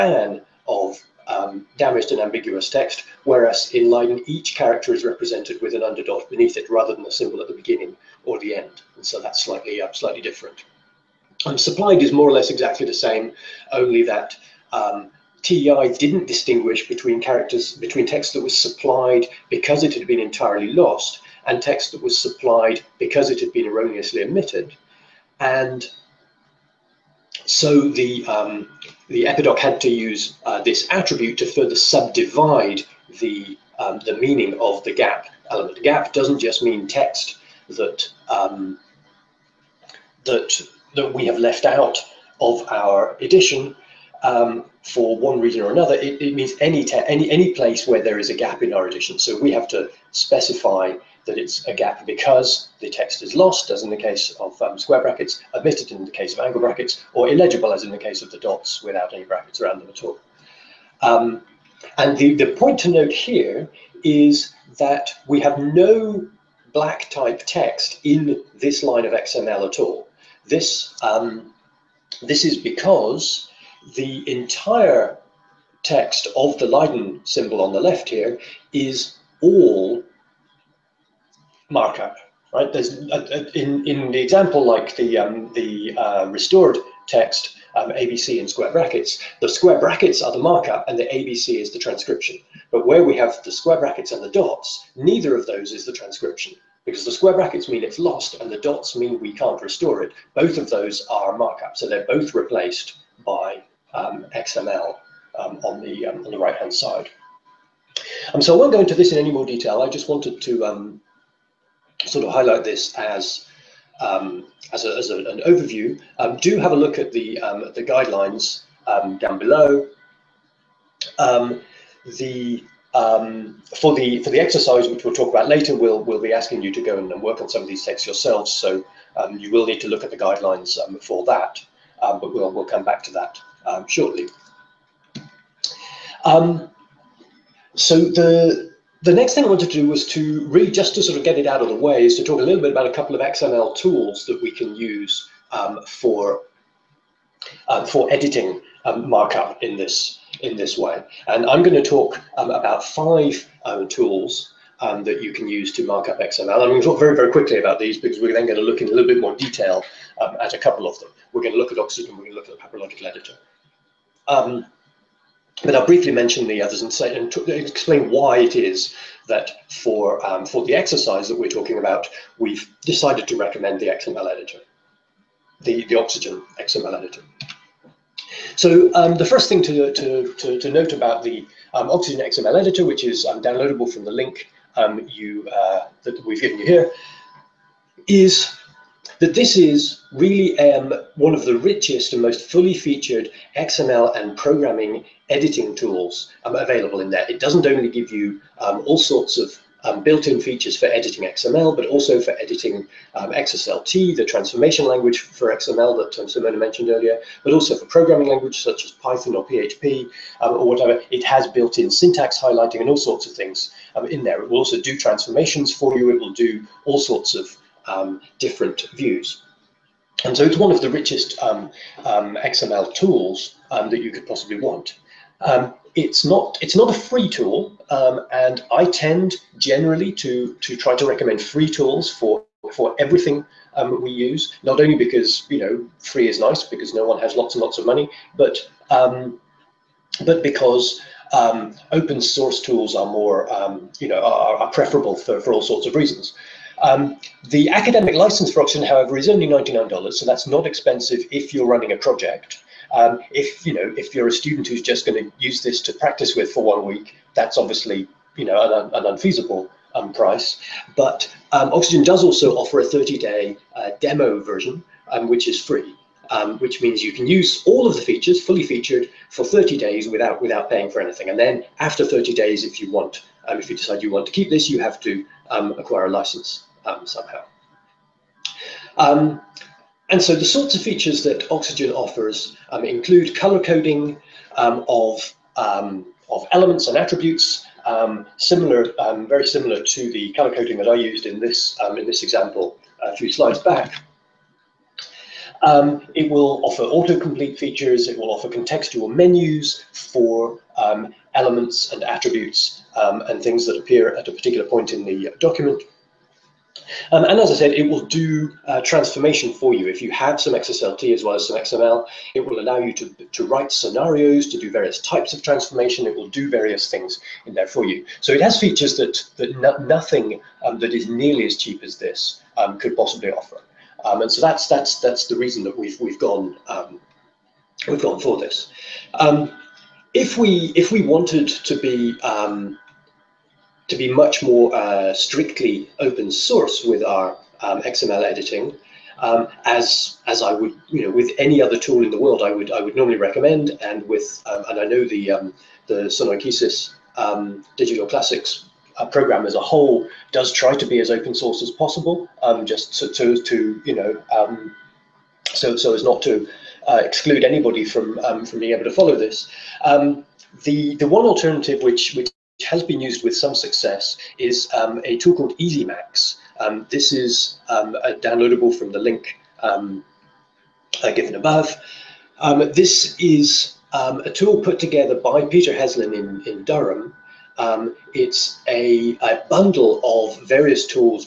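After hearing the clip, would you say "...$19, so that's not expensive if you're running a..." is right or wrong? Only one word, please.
wrong.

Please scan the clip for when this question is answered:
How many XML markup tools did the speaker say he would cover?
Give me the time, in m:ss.
2:32.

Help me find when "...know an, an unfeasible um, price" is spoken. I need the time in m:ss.
4:18.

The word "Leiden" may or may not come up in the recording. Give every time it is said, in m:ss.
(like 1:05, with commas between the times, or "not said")
0:03, 1:16.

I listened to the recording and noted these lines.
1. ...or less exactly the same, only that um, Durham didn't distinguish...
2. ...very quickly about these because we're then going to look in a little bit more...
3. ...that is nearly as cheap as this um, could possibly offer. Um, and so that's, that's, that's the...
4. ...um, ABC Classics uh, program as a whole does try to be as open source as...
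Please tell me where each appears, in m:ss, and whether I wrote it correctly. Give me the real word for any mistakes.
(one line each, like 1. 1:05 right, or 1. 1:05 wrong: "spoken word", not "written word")
1. 0:12 wrong: "TEI", not "Durham"
2. 2:37 right
3. 5:20 right
4. 5:47 wrong: "Digital", not "ABC".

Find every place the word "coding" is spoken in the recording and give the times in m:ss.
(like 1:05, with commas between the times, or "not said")
4:43, 4:50.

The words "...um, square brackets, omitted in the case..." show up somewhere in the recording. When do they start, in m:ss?
0:54.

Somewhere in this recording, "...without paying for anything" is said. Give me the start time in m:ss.
4:30.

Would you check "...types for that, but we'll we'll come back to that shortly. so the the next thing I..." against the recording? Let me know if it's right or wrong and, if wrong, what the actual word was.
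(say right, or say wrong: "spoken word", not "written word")
wrong: "guidelines", not "types".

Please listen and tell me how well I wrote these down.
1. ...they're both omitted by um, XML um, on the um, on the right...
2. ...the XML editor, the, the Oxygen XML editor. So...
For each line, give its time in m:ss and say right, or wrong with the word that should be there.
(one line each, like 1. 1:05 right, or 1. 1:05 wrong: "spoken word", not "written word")
1. 1:41 wrong: "replaced", not "omitted"
2. 2:53 right.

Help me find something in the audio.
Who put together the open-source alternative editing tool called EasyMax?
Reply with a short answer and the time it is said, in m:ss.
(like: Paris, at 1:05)
Peter Heslin, at 6:15.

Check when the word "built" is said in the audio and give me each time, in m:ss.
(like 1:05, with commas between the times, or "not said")
3:20, 3:31.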